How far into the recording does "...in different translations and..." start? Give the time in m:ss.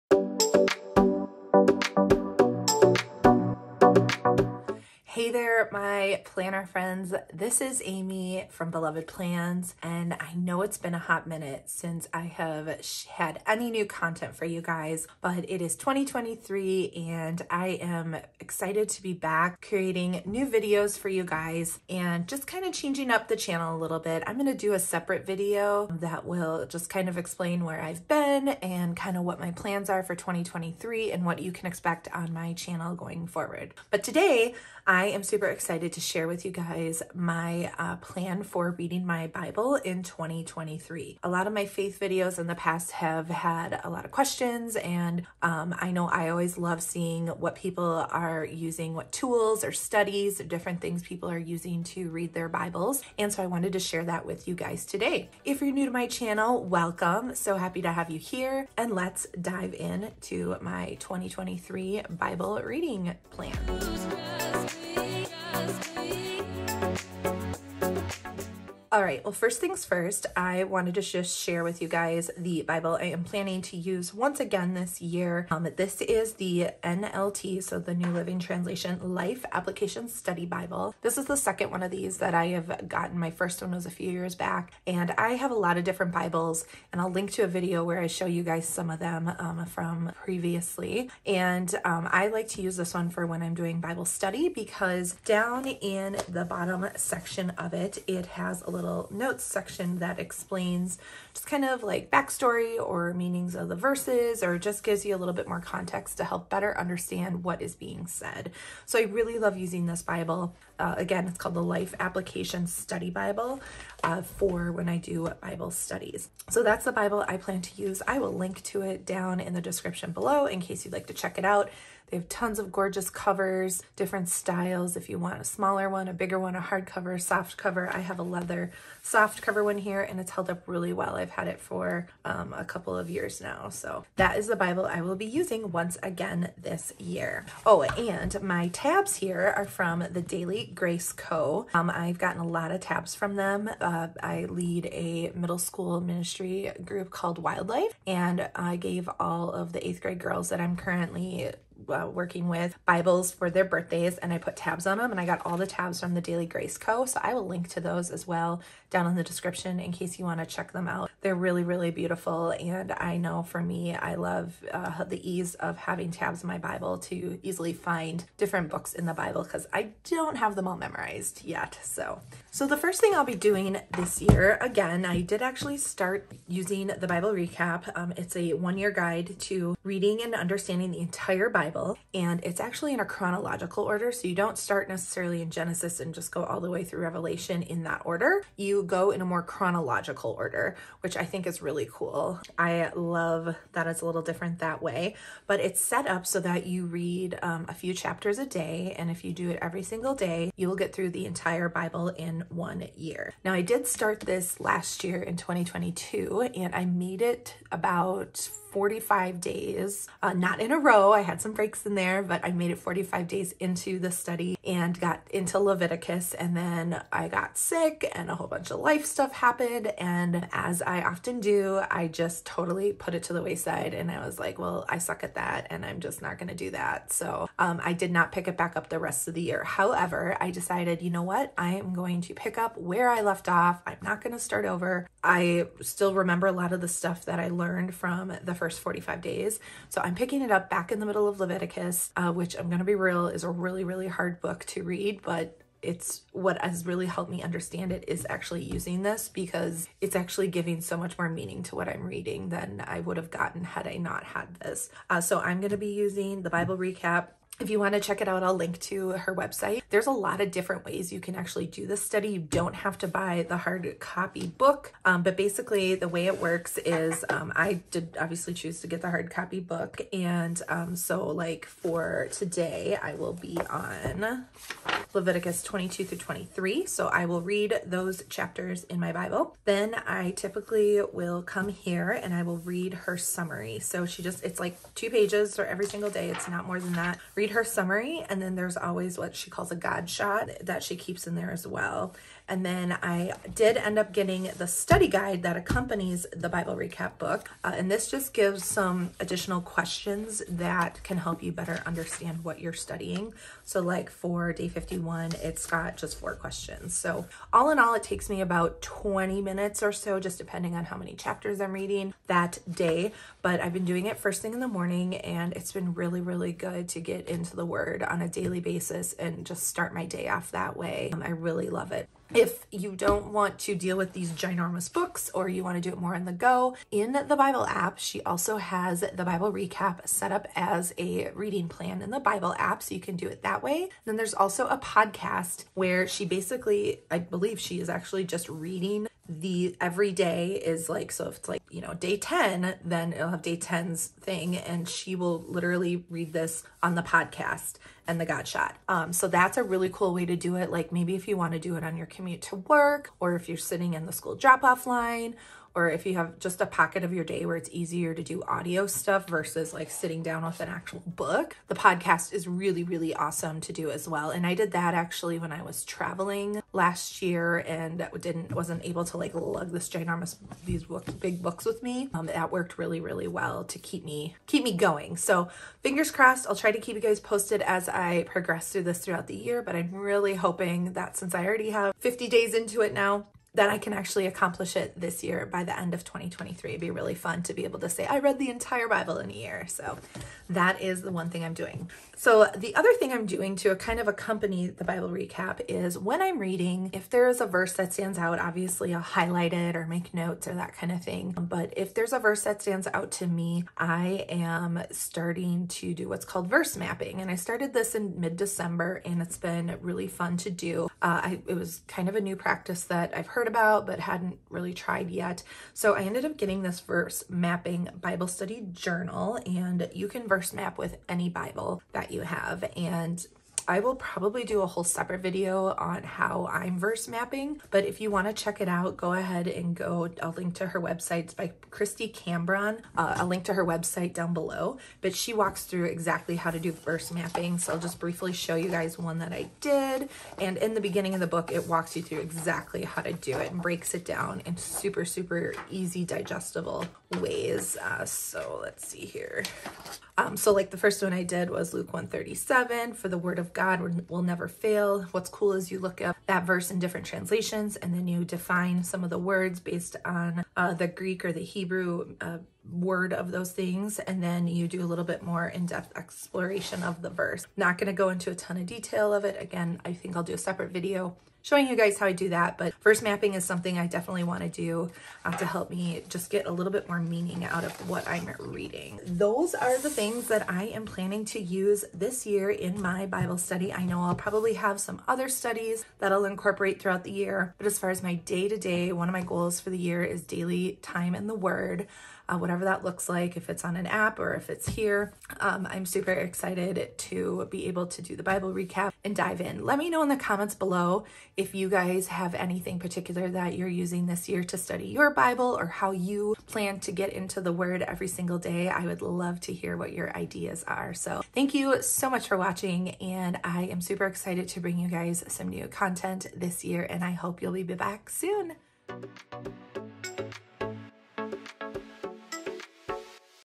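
7:36.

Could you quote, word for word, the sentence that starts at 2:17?
Oh, and my tabs here are from the Daily Grace Co.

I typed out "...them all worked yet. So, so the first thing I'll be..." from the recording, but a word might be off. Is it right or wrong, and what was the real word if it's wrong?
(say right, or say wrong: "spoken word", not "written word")
wrong: "memorized", not "worked".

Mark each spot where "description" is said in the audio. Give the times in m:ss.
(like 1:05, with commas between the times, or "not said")
1:59, 2:39.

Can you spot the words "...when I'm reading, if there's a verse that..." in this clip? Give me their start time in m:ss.
6:35.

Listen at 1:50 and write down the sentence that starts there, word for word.
Uh, again, it's called the Life Application Study Bible uh, for when I do Bible studies.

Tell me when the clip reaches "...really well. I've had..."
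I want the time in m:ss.
2:10.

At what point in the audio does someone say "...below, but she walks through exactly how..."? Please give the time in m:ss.
7:14.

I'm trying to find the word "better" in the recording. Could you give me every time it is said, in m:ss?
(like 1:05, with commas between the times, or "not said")
1:46, 5:01.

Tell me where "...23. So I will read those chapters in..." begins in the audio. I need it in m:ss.
4:36.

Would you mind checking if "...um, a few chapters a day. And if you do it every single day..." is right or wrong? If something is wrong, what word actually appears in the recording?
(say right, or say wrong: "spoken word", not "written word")
right.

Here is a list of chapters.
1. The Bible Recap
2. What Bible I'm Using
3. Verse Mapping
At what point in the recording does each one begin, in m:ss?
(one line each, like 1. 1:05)
1. 2:53
2. 1:14
3. 6:32.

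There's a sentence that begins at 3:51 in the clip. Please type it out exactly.
I am going to pick up where I left off.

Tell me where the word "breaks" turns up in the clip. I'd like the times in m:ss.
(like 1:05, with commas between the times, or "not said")
3:31, 7:23.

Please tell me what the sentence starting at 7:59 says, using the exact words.
Those are the things that I am planning to use this year in my Bible study.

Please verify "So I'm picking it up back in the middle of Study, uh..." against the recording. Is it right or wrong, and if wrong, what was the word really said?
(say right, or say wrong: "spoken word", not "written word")
wrong: "Leviticus", not "Study".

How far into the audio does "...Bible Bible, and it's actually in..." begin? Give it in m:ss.
3:01.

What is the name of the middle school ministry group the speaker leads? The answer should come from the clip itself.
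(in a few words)
WyldLife.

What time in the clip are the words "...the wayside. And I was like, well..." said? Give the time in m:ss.
3:43.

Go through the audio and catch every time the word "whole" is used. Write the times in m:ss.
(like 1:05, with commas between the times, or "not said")
3:38, 7:04.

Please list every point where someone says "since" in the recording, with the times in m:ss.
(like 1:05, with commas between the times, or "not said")
0:11, 6:21.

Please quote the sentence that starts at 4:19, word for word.
There's a lot of different ways you can actually do this study.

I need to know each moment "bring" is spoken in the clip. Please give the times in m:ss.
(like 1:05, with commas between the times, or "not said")
8:34.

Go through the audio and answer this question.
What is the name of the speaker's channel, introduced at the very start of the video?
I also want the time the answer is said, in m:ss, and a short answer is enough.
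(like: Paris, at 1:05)
Beloved Plans, at 0:08.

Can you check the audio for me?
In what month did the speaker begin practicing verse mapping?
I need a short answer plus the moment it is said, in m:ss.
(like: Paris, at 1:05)
December, at 6:48.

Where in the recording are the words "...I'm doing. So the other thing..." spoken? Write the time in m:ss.
6:31.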